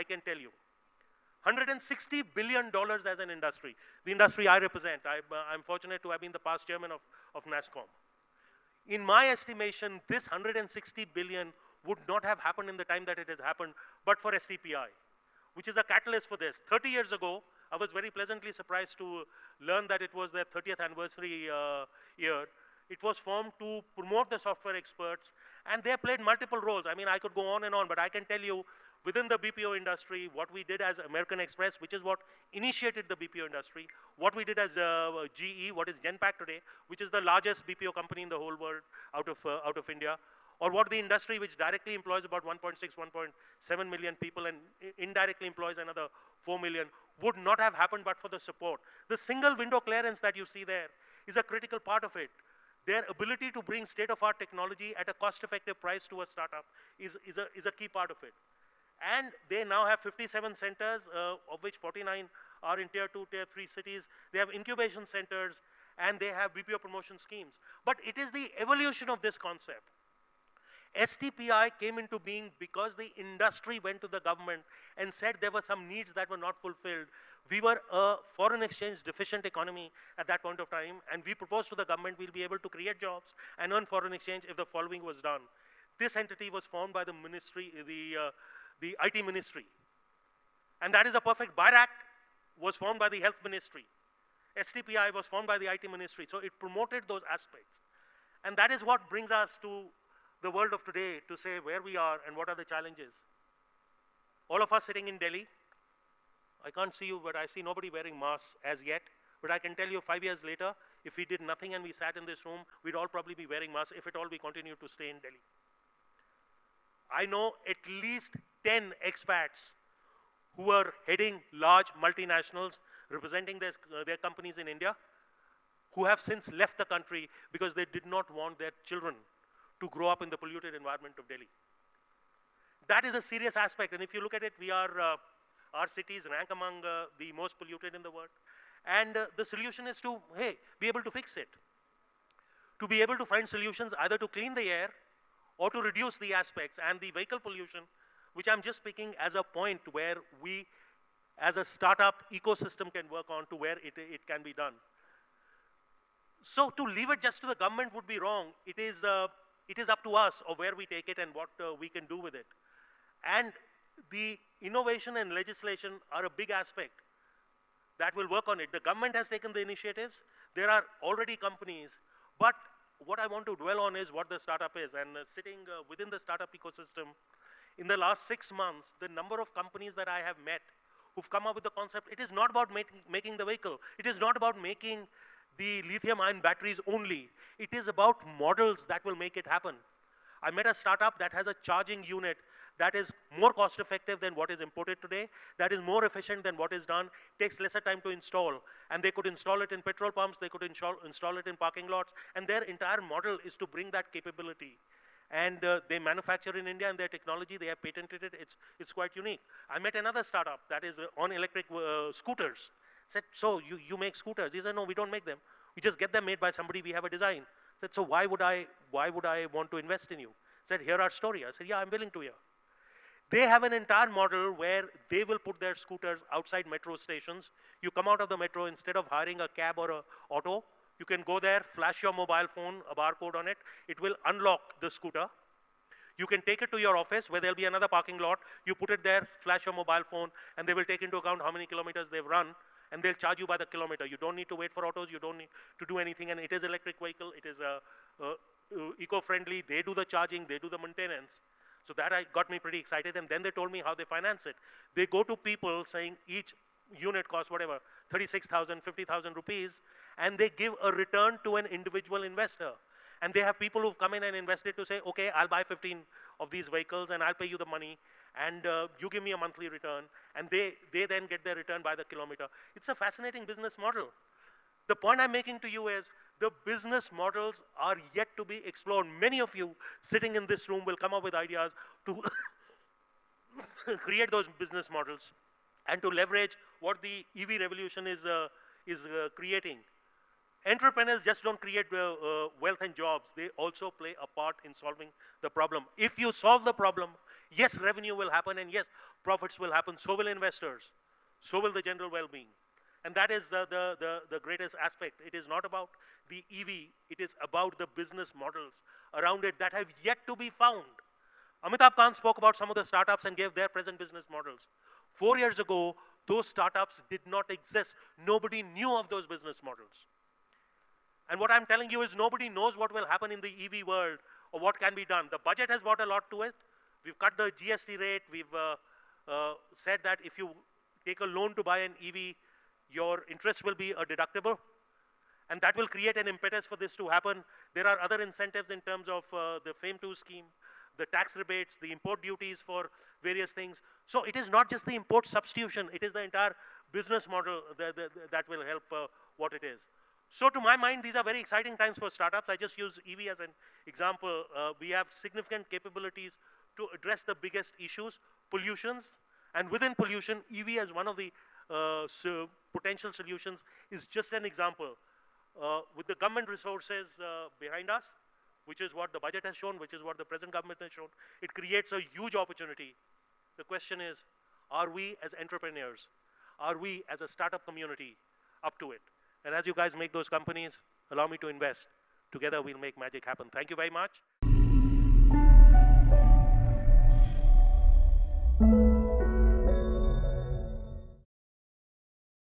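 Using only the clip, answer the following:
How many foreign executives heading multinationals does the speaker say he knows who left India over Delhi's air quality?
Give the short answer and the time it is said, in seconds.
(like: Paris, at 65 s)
10, at 118 s.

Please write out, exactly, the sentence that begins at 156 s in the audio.
So to leave it just to the government would be wrong.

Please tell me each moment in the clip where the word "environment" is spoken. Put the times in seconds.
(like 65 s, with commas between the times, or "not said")
130 s.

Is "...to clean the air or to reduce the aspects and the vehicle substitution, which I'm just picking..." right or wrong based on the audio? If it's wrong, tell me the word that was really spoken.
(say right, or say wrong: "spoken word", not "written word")
wrong: "pollution", not "substitution".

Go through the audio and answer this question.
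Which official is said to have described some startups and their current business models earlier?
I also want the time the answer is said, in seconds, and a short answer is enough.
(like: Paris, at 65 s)
Amitabh Kant, at 311 s.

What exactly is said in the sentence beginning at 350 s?
So to my mind, these are very exciting times for startups.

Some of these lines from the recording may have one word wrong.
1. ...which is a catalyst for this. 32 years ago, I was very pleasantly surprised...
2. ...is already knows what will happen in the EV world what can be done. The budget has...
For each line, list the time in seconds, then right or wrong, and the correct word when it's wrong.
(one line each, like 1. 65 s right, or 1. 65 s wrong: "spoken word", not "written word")
1. 15 s wrong: "30", not "32"
2. 322 s wrong: "nobody", not "already".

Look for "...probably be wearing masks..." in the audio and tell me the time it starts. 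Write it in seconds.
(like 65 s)
113 s.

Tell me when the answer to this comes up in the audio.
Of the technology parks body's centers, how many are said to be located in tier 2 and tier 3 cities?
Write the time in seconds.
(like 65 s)
61 s.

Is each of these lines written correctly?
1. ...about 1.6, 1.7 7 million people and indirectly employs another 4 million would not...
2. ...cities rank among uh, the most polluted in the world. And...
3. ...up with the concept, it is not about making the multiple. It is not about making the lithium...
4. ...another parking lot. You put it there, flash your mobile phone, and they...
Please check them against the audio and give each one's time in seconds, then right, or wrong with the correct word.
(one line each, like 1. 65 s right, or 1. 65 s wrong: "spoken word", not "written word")
1. 42 s right
2. 135 s right
3. 181 s wrong: "vehicle", not "multiple"
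4. 237 s right.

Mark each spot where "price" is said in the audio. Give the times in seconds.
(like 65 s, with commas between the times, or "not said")
55 s.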